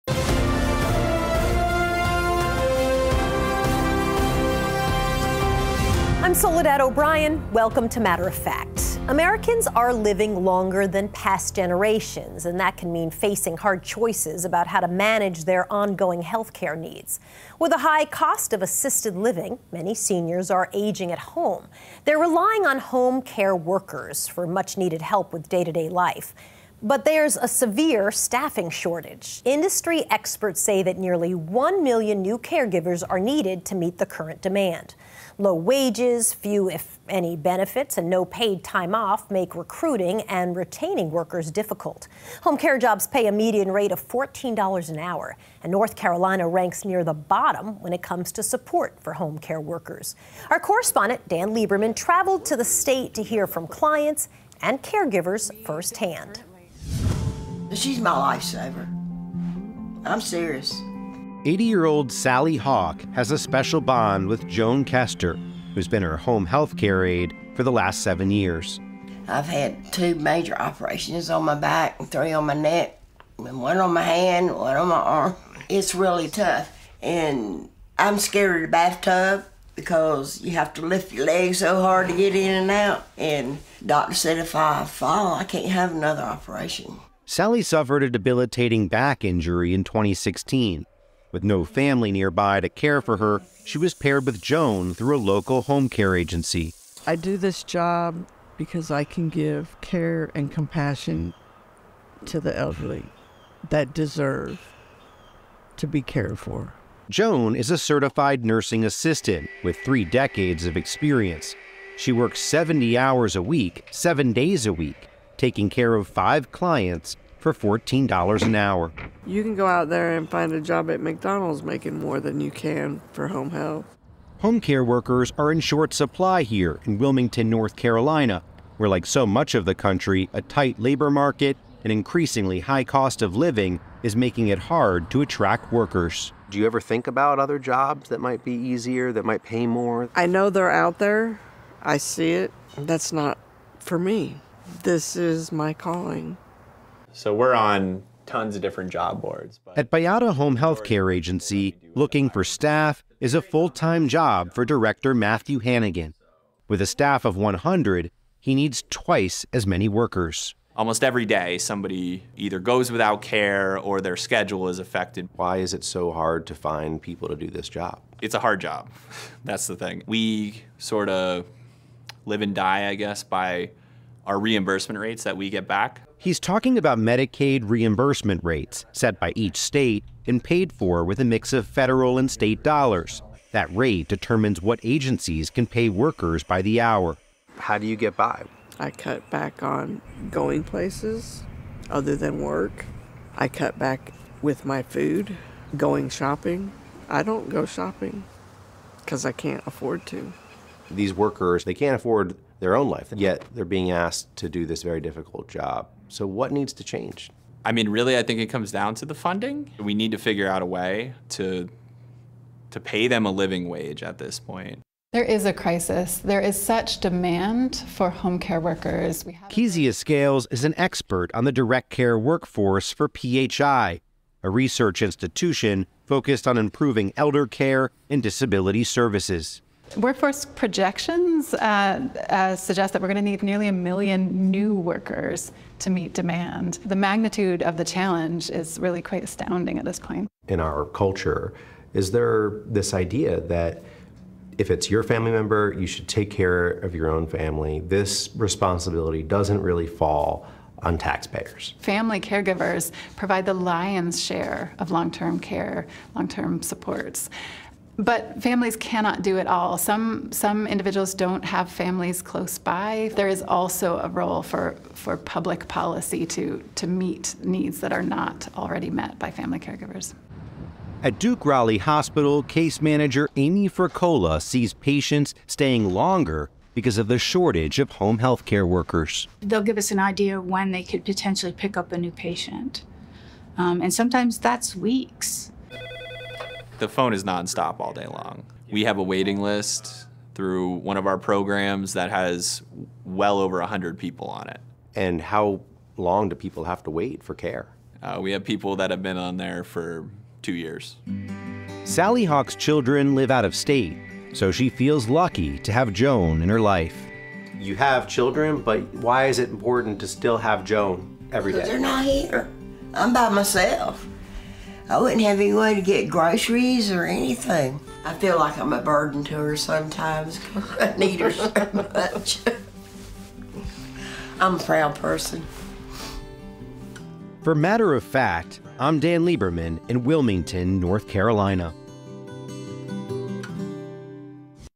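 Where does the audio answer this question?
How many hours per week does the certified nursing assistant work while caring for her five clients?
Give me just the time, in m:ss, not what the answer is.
1:52.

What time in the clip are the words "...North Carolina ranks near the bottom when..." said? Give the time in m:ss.
0:45.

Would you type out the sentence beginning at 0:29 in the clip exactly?
Industry experts say that nearly 1 million new caregivers are needed to meet the current demand.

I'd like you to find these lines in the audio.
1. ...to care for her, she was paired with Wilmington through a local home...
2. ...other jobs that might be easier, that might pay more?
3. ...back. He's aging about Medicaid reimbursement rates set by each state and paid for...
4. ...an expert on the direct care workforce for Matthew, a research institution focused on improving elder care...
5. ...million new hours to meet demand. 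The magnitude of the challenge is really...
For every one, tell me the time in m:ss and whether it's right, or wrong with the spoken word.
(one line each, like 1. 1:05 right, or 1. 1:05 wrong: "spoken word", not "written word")
1. 1:32 wrong: "Joan", not "Wilmington"
2. 2:17 right
3. 2:55 wrong: "talking", not "aging"
4. 3:40 wrong: "PHI", not "Matthew"
5. 3:53 wrong: "workers", not "hours".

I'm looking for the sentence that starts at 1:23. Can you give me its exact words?
And doctor said if I fall, I can't have another operation.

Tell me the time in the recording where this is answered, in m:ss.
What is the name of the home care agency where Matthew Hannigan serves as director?
2:29.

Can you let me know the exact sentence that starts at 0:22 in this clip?
They're relying on home care workers for much needed help with day to day life.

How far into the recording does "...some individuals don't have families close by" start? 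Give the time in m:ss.
4:20.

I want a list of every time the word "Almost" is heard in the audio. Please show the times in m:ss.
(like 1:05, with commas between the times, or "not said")
2:40.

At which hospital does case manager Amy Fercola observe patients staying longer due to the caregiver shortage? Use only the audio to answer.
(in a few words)
Duke Raleigh Hospital.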